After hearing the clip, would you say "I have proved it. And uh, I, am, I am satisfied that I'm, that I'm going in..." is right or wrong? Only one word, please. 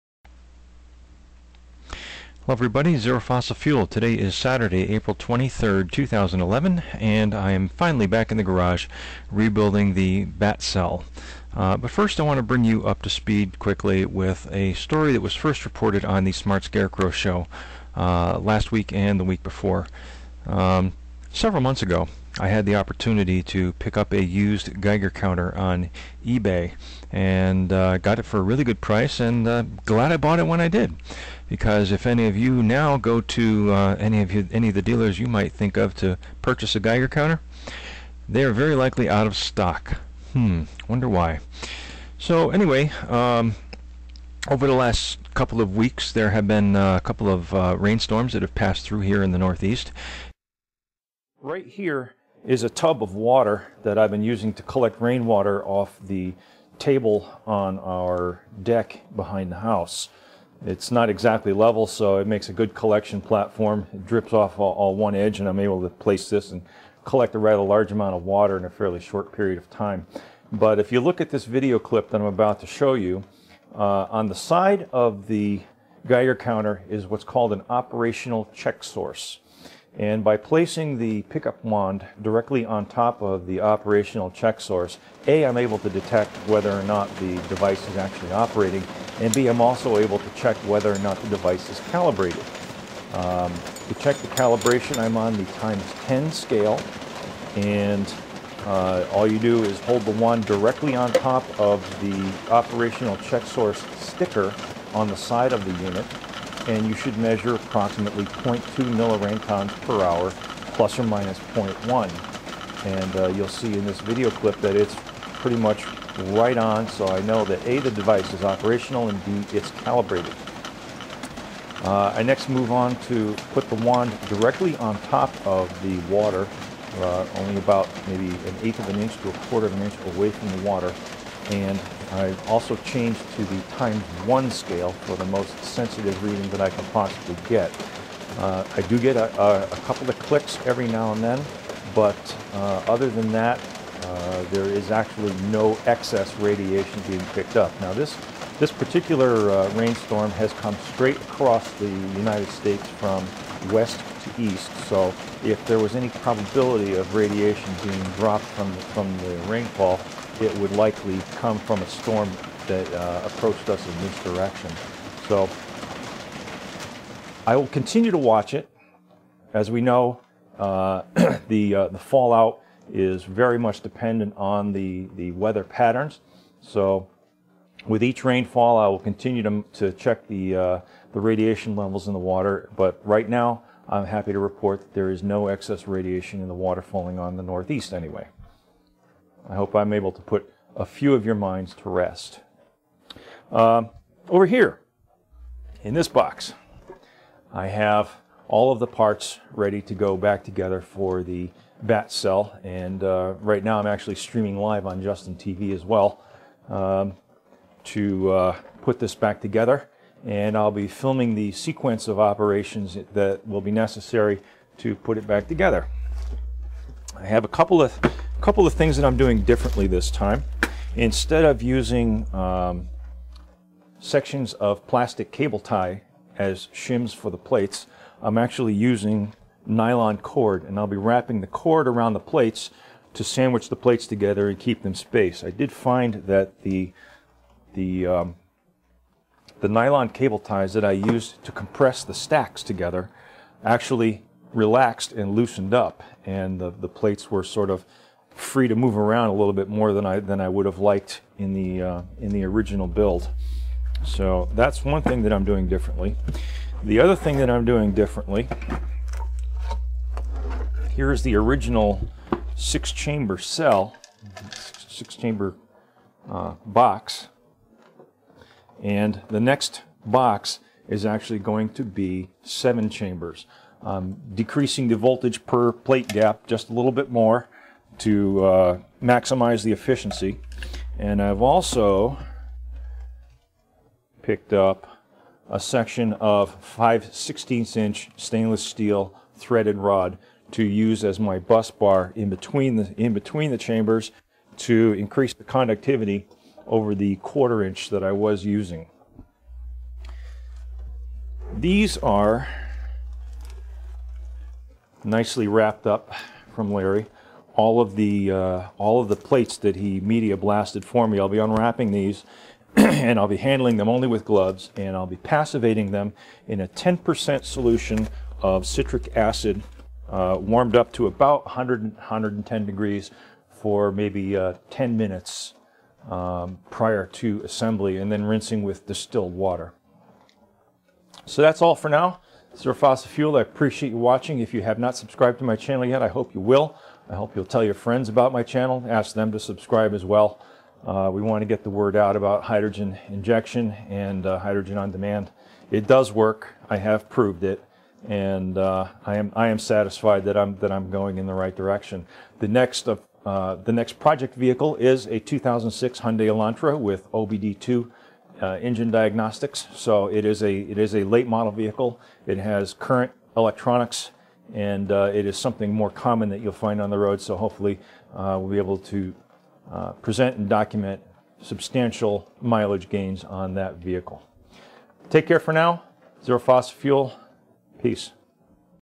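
right.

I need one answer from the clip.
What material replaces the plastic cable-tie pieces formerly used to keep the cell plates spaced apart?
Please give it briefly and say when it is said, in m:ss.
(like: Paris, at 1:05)
nylon cord, at 3:49.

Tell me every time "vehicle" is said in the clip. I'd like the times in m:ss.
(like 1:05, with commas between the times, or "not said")
5:54, 6:01, 6:13.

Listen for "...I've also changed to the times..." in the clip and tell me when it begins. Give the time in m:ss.
2:12.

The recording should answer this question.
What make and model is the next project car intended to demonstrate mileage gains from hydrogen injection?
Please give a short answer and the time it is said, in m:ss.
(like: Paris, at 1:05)
2006 Hyundai Elantra, at 5:55.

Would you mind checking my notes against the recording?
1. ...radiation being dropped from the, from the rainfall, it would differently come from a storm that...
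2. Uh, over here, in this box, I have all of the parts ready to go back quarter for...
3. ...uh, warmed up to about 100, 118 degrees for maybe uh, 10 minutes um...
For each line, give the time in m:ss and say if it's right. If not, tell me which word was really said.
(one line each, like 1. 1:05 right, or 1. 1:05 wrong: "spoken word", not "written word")
1. 2:37 wrong: "likely", not "differently"
2. 3:13 wrong: "together", not "quarter"
3. 5:20 wrong: "110", not "118".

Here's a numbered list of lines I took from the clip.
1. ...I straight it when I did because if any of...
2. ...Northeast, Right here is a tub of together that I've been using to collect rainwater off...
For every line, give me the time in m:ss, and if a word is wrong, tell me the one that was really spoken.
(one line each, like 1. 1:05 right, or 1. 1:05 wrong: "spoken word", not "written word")
1. 0:30 wrong: "bought", not "straight"
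2. 0:49 wrong: "water", not "together".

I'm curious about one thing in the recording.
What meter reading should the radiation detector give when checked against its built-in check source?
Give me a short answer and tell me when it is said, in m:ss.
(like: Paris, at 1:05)
0.2 milliroentgens per hour, at 1:48.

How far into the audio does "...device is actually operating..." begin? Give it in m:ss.
1:27.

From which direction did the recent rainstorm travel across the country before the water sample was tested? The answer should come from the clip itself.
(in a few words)
west to east.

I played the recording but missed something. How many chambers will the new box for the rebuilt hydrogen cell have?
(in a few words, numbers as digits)
7.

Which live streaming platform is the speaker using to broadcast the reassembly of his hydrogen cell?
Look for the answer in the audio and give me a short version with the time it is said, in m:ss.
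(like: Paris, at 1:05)
Justin TV, at 3:25.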